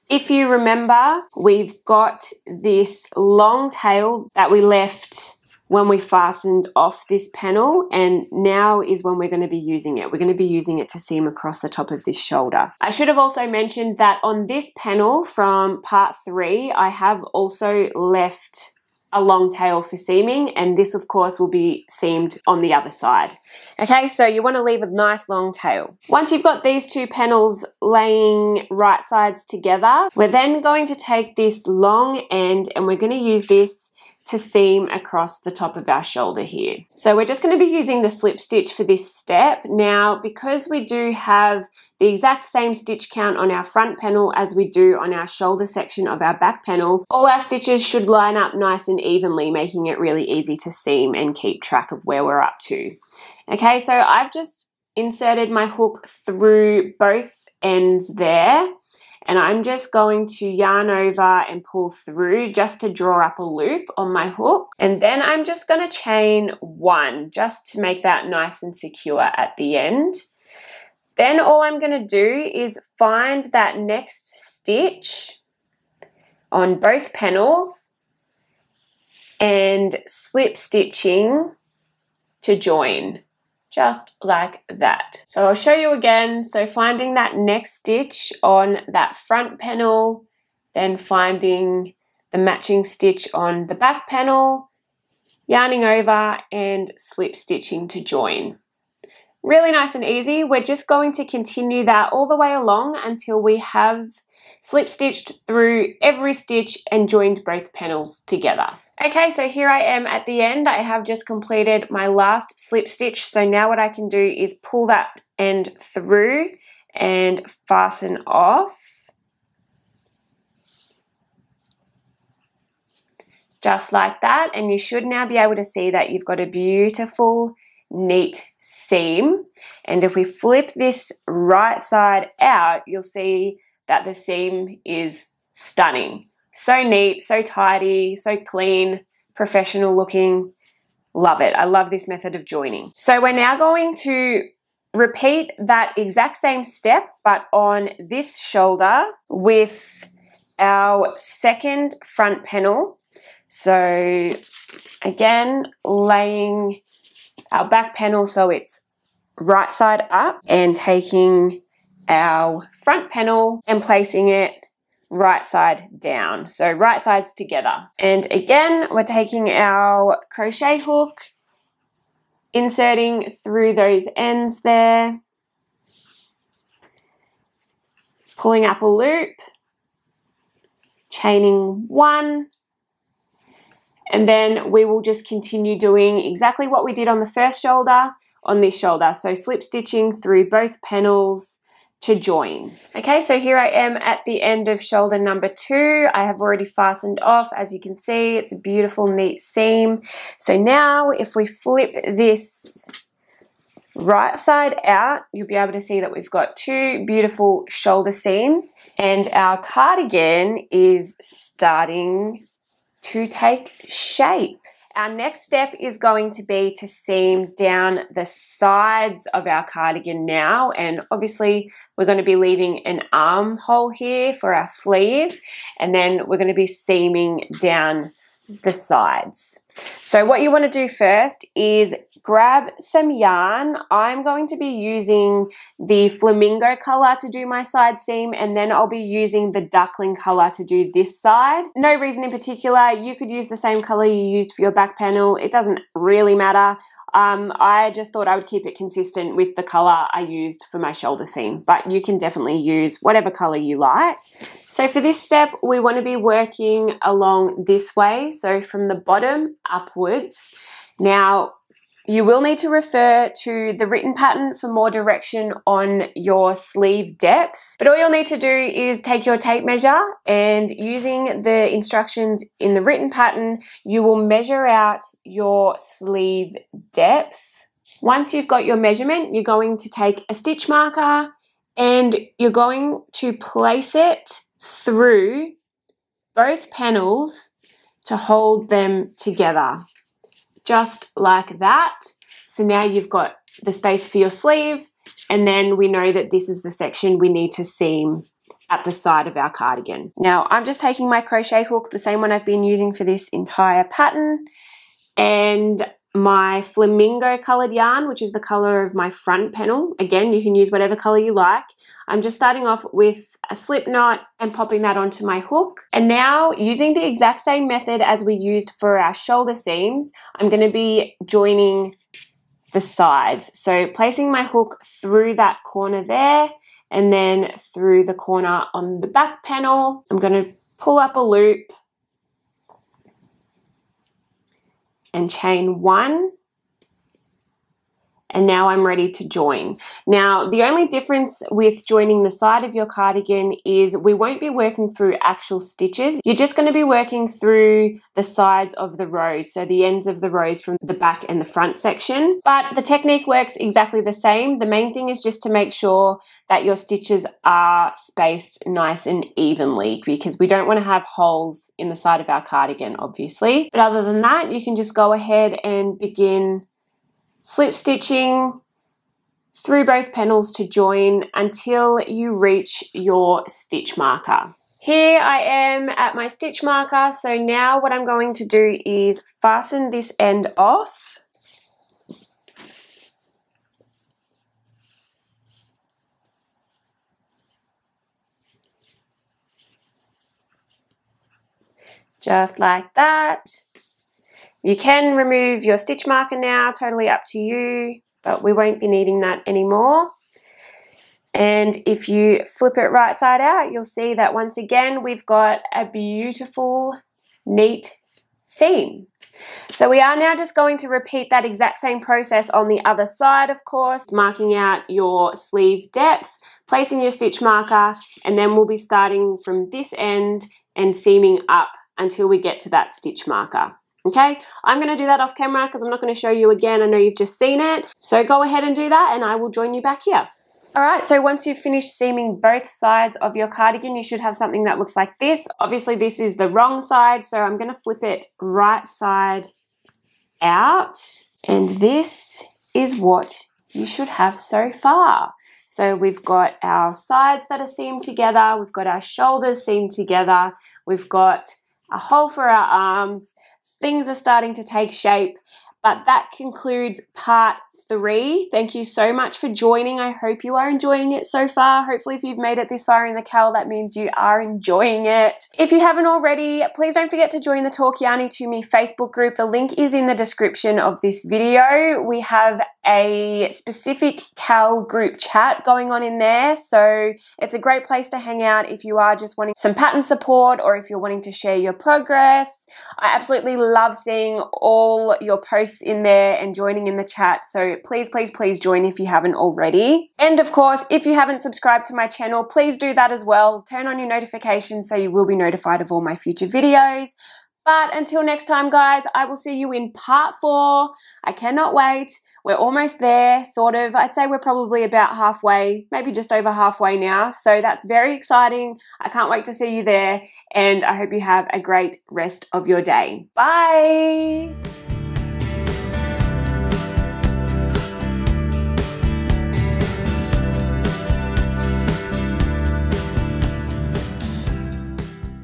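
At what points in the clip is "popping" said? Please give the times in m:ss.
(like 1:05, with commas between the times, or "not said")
5:14.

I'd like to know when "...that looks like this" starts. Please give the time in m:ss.
7:14.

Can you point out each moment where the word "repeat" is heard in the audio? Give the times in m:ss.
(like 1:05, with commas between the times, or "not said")
2:24, 6:50.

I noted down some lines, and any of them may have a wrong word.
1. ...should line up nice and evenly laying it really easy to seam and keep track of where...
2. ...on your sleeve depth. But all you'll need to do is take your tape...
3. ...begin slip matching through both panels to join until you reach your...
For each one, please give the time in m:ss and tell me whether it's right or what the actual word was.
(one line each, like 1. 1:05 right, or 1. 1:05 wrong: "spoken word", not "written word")
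1. 0:47 wrong: "making", not "laying"
2. 4:25 right
3. 6:05 wrong: "stitching", not "matching".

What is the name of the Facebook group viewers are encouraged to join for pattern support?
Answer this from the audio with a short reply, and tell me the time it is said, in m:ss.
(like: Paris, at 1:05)
Talk Yarny to Me, at 7:47.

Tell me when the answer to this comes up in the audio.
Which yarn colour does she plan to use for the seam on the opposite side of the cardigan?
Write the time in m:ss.
3:59.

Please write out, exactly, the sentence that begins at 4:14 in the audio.
So for this step, we want to be working along this way.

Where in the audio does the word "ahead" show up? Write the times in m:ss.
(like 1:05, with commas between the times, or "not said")
6:05, 7:08.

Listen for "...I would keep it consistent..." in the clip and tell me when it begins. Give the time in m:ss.
4:08.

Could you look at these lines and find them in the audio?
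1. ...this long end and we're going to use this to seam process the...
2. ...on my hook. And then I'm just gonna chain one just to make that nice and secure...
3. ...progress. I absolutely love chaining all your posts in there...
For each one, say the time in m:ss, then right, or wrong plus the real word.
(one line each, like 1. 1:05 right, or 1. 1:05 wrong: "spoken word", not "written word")
1. 0:31 wrong: "across", not "process"
2. 1:03 right
3. 8:01 wrong: "seeing", not "chaining".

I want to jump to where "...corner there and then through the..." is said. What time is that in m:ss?
5:25.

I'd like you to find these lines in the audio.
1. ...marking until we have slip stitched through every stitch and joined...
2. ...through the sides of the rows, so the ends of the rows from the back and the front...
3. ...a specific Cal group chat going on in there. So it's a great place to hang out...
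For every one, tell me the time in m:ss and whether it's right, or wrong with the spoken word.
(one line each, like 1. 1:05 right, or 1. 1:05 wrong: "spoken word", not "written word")
1. 1:42 wrong: "along", not "marking"
2. 5:47 right
3. 7:52 right.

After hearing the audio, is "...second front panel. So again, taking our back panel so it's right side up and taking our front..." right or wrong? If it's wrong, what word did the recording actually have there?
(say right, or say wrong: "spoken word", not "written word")
wrong: "laying", not "taking".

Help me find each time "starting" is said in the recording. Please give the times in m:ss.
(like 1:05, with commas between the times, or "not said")
3:31, 5:12, 6:58, 7:34.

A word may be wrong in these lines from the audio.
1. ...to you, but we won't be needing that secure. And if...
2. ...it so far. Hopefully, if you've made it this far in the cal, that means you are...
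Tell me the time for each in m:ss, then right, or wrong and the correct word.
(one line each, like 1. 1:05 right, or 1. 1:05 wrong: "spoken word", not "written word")
1. 6:37 wrong: "anymore", not "secure"
2. 7:41 right.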